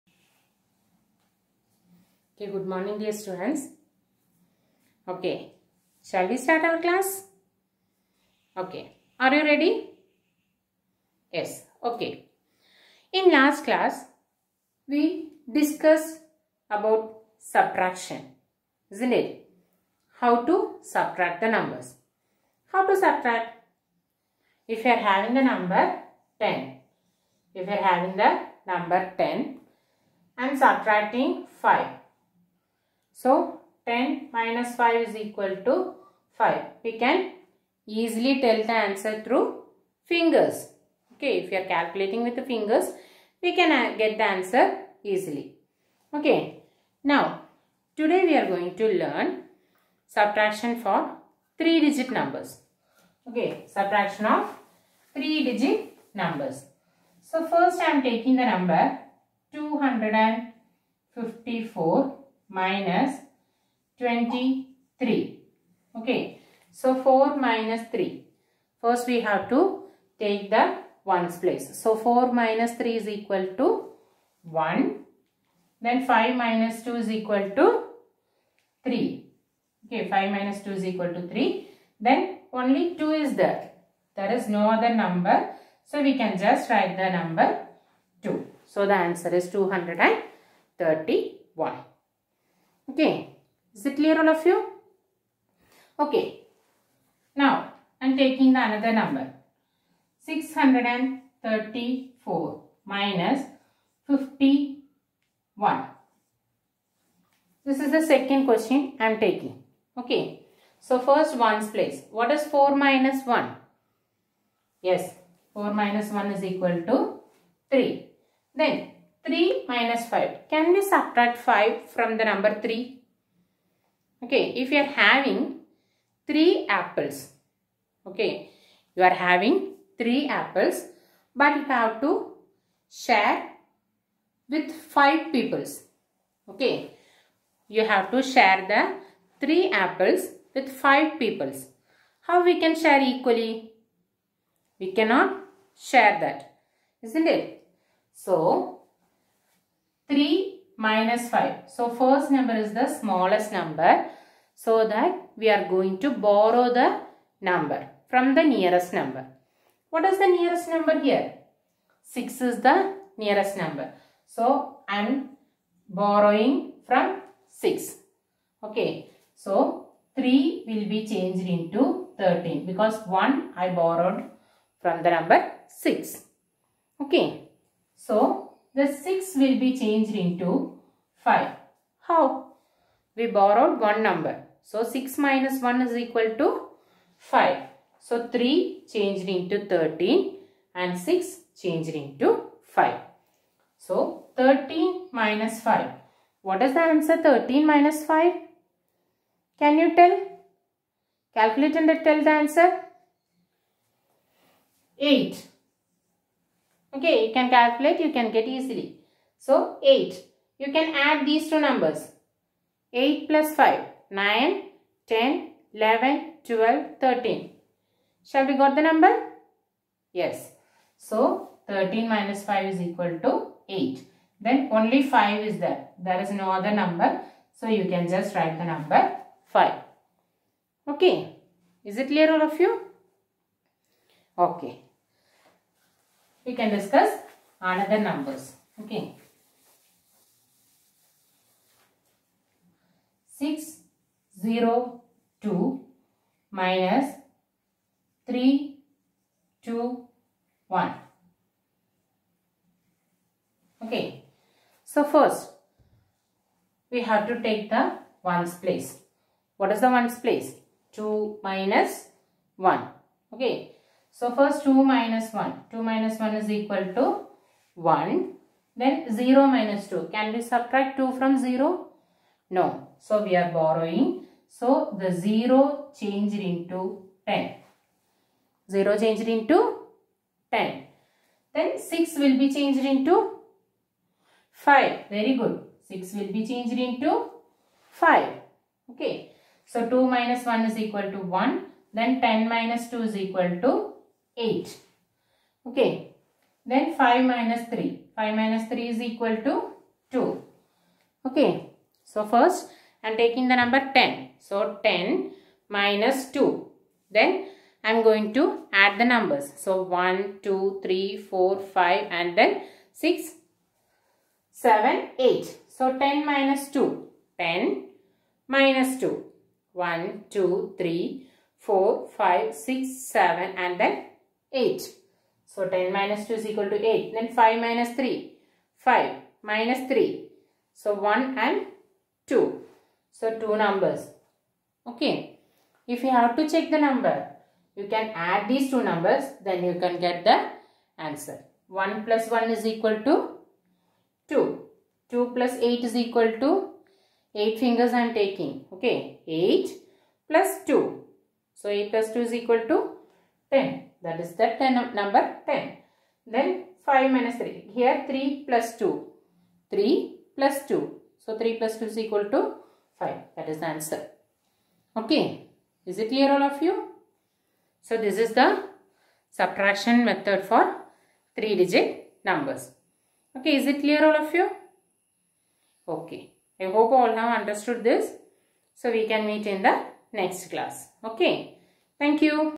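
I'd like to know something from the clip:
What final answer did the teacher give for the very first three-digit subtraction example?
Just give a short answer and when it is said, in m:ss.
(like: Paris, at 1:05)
231, at 1:29.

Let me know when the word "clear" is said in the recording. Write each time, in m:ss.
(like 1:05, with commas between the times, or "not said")
1:33, 3:52, 6:06, 6:13.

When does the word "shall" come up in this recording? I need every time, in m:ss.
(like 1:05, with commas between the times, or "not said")
0:06, 3:38.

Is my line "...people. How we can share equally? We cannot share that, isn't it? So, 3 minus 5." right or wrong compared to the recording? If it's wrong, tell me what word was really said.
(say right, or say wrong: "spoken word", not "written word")
right.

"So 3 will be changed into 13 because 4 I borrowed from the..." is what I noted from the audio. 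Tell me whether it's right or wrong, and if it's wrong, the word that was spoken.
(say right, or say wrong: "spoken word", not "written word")
wrong: "1", not "4".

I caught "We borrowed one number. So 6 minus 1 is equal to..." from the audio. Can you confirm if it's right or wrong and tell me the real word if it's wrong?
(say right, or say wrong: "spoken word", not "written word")
right.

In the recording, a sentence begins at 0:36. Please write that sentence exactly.
We can easily tell the answer through fingers.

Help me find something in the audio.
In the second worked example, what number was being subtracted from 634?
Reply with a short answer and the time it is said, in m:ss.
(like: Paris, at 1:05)
51, at 1:44.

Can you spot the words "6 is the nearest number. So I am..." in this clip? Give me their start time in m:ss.
2:42.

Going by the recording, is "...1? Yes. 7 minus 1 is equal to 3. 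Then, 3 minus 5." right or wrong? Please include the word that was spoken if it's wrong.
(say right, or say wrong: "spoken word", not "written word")
wrong: "4", not "7".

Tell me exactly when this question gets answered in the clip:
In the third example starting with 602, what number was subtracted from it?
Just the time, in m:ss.
4:08.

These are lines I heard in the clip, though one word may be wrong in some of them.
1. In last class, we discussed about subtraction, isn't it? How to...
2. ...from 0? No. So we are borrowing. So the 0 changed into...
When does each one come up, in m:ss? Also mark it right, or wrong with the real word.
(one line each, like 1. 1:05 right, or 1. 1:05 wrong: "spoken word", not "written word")
1. 0:13 right
2. 4:31 right.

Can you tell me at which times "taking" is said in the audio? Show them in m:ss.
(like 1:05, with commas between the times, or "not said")
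0:58, 1:38, 1:49, 5:03, 5:48.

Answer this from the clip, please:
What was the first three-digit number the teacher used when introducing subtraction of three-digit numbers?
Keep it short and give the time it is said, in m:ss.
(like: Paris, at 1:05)
254, at 0:59.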